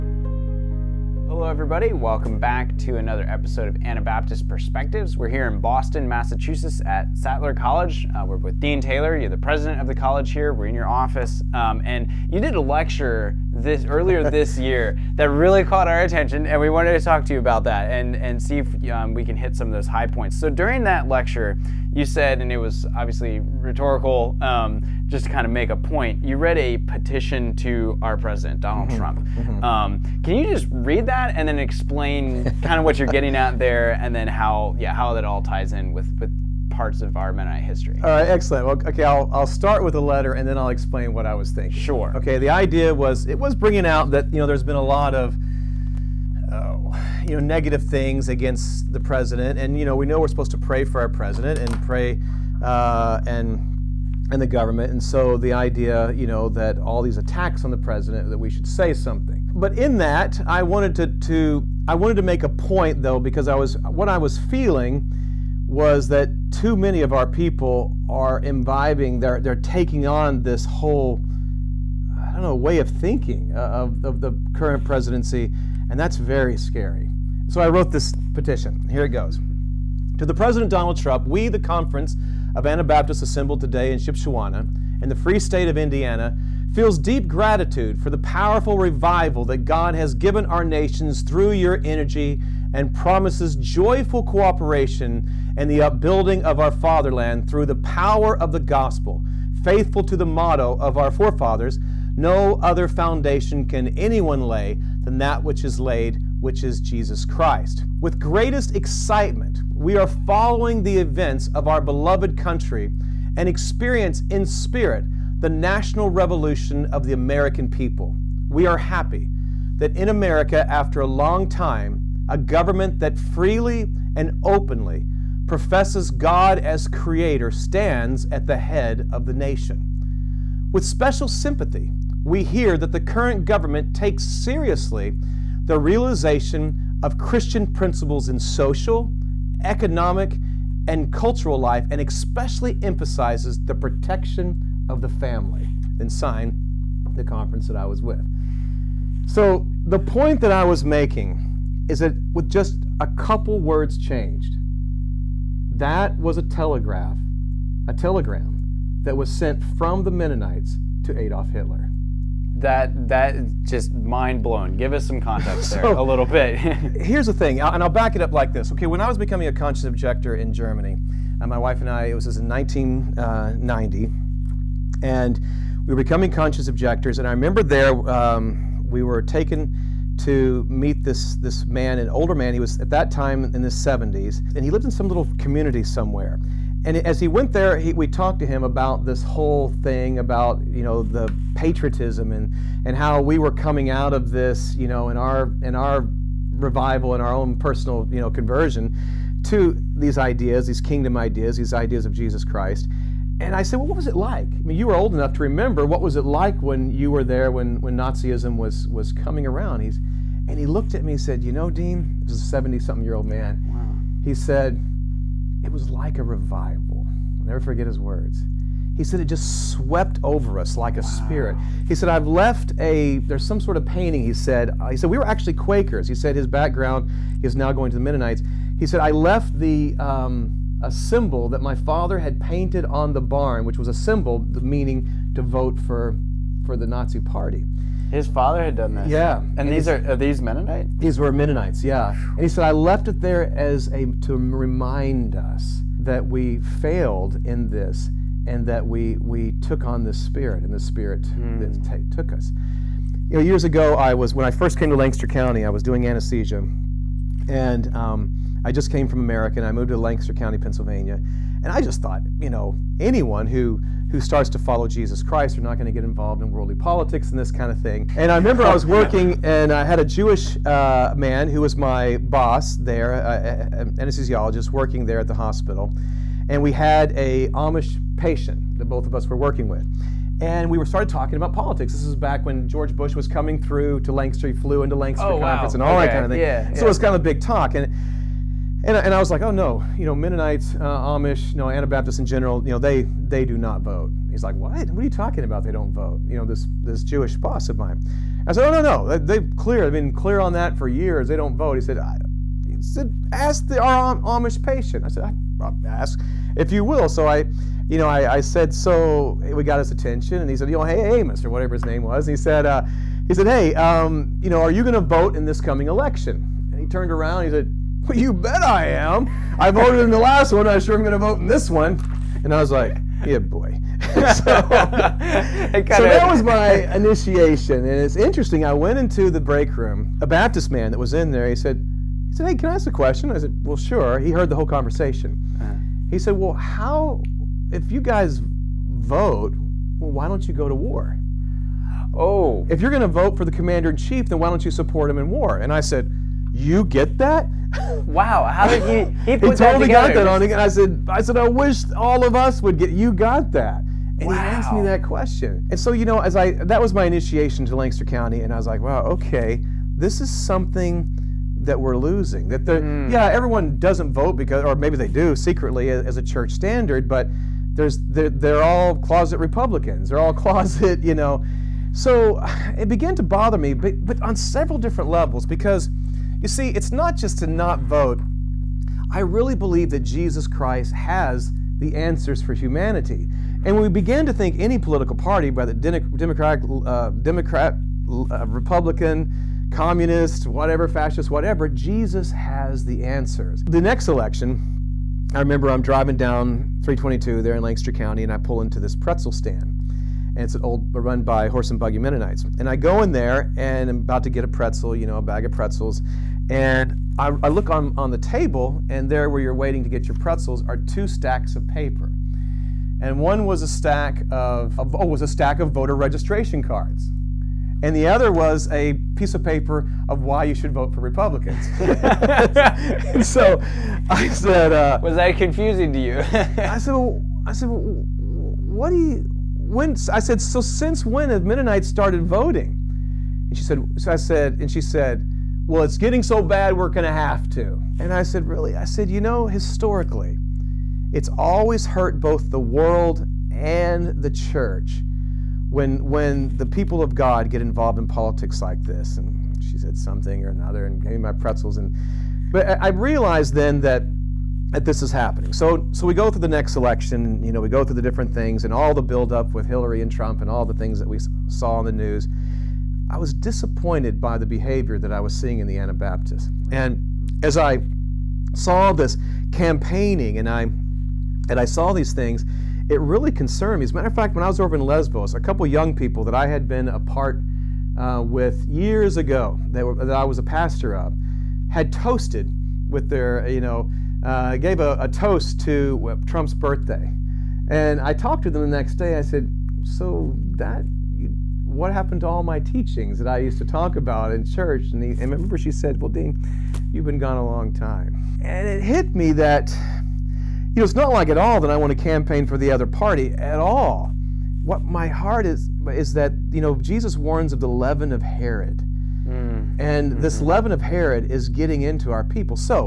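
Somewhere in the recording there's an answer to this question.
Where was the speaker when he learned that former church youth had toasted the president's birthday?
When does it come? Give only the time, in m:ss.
7:54.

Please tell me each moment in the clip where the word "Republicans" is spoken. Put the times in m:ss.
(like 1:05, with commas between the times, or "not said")
6:09, 6:28, 7:01.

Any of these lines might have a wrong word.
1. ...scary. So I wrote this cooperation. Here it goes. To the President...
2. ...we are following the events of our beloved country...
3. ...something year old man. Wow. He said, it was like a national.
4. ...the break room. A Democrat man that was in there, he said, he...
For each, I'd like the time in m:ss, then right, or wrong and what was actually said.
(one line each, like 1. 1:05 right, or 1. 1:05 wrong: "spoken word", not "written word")
1. 1:16 wrong: "petition", not "cooperation"
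2. 1:49 right
3. 3:32 wrong: "revival", not "national"
4. 5:29 wrong: "Baptist", not "Democrat".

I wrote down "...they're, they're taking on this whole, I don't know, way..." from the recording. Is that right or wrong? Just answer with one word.
right.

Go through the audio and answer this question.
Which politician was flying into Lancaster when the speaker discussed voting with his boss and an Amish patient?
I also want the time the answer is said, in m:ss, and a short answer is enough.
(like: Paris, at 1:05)
George Bush, at 4:42.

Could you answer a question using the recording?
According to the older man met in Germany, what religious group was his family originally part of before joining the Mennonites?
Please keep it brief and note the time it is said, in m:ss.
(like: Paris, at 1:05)
Quakers, at 3:45.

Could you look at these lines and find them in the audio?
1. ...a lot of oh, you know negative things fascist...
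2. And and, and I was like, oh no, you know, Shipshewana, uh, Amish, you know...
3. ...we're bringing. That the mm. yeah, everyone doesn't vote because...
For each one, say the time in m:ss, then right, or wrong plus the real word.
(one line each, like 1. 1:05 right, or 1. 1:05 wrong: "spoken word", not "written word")
1. 0:44 wrong: "against", not "fascist"
2. 4:47 wrong: "Mennonites", not "Shipshewana"
3. 6:01 wrong: "losing", not "bringing".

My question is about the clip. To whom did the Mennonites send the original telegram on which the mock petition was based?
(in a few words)
Adolf Hitler.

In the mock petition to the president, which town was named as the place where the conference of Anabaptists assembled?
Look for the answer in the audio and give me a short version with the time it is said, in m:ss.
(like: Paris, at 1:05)
Shipshewana, at 1:23.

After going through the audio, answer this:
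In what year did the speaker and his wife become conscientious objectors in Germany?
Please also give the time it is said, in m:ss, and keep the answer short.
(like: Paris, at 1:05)
1990, at 2:52.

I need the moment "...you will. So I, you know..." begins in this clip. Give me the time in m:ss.
5:06.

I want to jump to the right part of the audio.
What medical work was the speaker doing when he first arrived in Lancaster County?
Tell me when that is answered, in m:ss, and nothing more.
4:16.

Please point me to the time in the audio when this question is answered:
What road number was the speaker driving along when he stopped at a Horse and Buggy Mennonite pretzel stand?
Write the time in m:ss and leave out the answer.
6:36.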